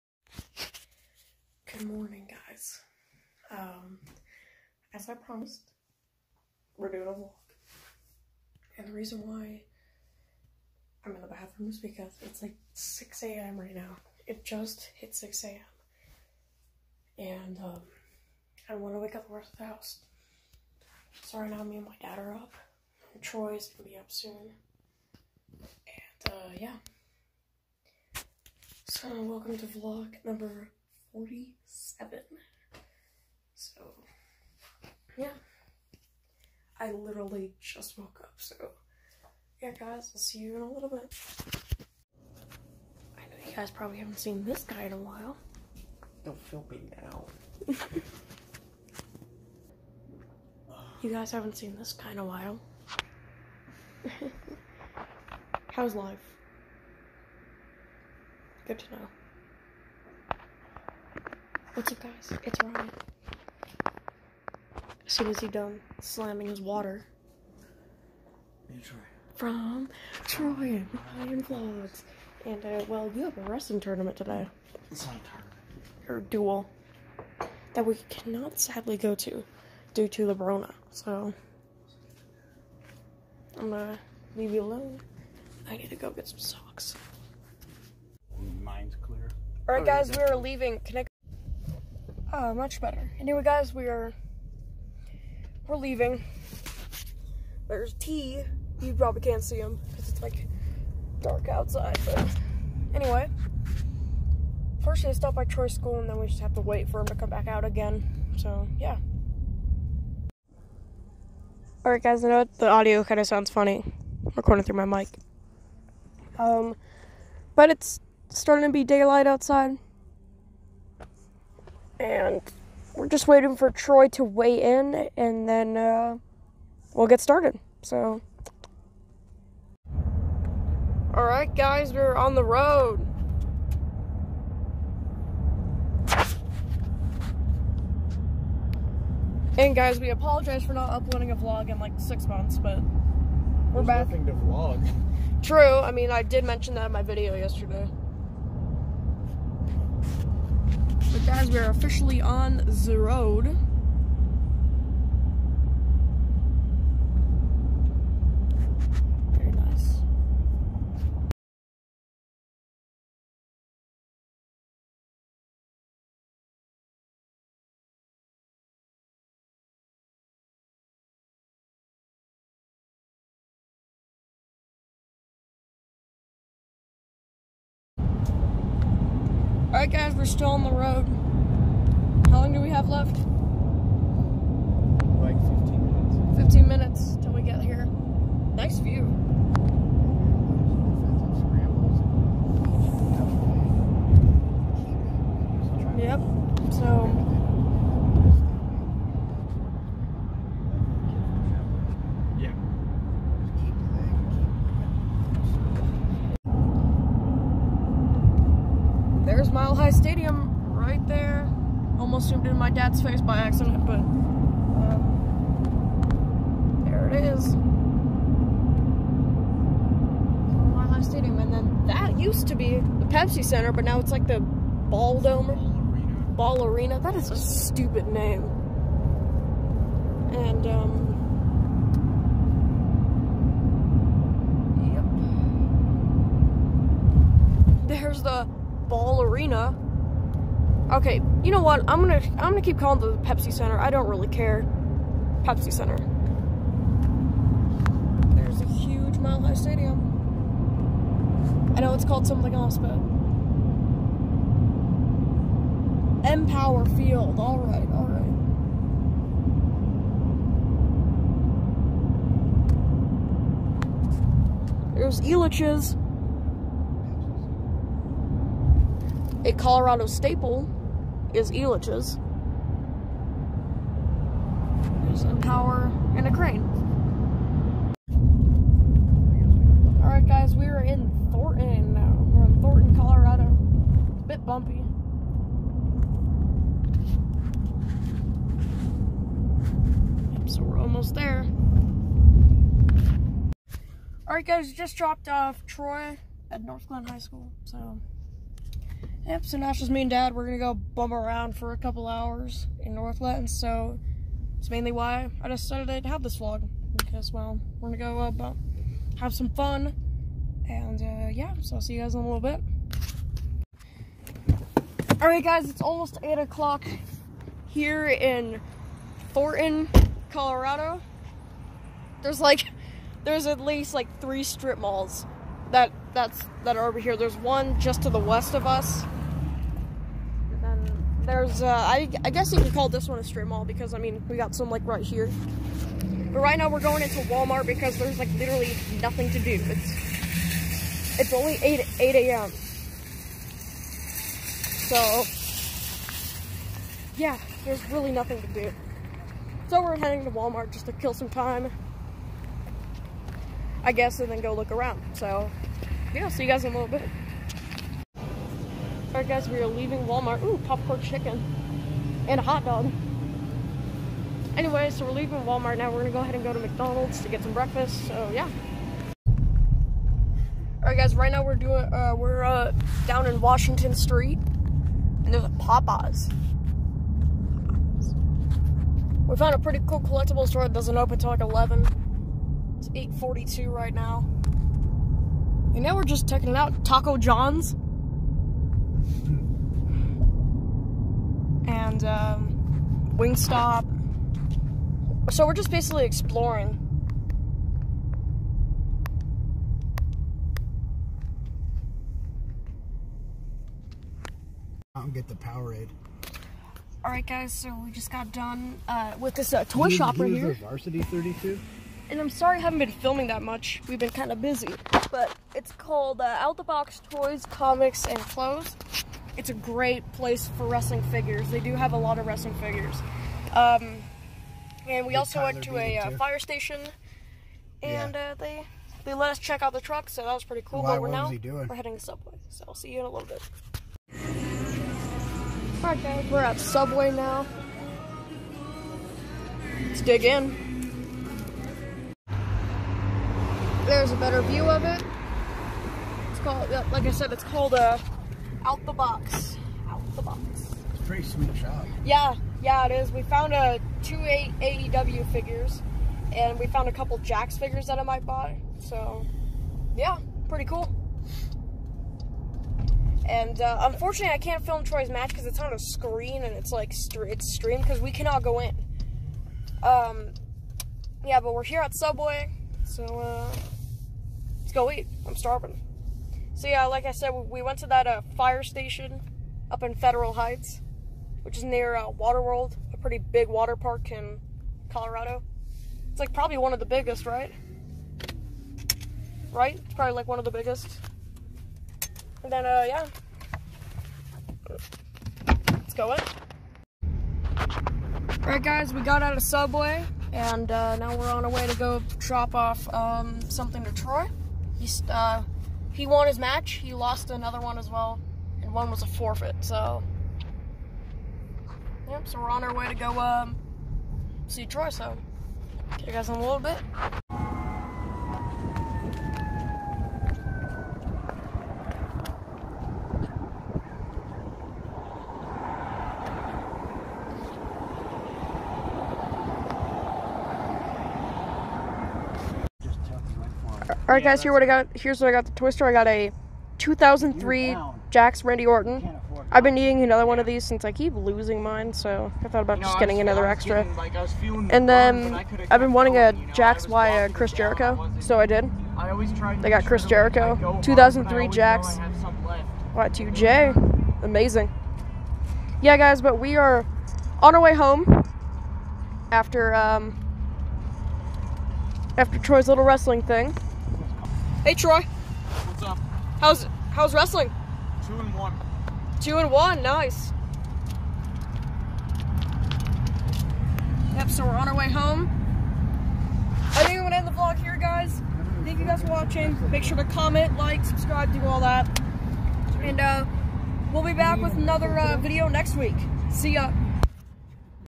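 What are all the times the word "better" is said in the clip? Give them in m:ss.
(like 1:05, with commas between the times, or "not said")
1:32, 7:24.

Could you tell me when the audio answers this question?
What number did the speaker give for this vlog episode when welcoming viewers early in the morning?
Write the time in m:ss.
0:29.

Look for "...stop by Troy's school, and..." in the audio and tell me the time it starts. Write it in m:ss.
1:45.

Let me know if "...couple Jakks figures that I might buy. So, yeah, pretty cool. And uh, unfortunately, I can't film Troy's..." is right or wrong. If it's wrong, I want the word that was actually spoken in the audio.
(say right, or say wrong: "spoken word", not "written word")
right.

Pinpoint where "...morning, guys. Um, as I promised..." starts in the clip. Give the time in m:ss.
0:01.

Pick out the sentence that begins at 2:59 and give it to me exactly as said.
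Alright guys, we're still on the road.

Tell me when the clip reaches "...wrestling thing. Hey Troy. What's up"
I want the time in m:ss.
9:22.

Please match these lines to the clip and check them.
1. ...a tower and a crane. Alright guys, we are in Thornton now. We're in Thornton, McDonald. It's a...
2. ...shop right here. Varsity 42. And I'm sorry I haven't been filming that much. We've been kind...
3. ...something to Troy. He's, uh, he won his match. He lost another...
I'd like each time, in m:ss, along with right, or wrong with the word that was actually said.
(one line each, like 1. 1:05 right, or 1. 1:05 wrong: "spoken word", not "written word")
1. 4:35 wrong: "Colorado", not "McDonald"
2. 6:49 wrong: "32", not "42"
3. 8:23 right.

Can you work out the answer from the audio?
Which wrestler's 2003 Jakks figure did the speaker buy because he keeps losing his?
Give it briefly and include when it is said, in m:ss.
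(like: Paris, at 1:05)
Randy Orton, at 8:58.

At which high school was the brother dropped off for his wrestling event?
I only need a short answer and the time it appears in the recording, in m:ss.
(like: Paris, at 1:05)
Northglenn High School, at 4:56.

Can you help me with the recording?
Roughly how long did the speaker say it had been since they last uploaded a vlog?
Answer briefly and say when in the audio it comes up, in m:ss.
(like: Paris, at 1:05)
six months, at 2:21.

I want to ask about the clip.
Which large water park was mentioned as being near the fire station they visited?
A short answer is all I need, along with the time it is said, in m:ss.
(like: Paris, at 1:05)
Waterworld, at 8:02.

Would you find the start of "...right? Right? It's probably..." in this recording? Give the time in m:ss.
8:07.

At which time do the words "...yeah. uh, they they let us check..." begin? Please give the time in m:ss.
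7:08.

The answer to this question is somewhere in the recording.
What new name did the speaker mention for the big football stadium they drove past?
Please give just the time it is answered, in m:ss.
4:16.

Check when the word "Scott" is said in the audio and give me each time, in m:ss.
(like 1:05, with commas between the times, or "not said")
not said.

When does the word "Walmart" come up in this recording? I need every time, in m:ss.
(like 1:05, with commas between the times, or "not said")
5:37, 5:50, 6:00, 6:05.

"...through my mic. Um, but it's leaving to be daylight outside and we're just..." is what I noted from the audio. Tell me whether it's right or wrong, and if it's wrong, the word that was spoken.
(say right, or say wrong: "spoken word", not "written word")
wrong: "starting", not "leaving".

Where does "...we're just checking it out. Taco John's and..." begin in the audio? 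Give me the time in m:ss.
6:25.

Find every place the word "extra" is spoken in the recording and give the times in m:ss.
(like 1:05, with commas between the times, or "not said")
9:03.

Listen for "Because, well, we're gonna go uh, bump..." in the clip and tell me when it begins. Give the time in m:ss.
5:06.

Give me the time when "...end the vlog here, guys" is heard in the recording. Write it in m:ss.
9:37.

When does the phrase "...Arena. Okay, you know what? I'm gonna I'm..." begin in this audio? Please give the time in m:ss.
3:59.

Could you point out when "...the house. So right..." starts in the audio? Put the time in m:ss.
0:19.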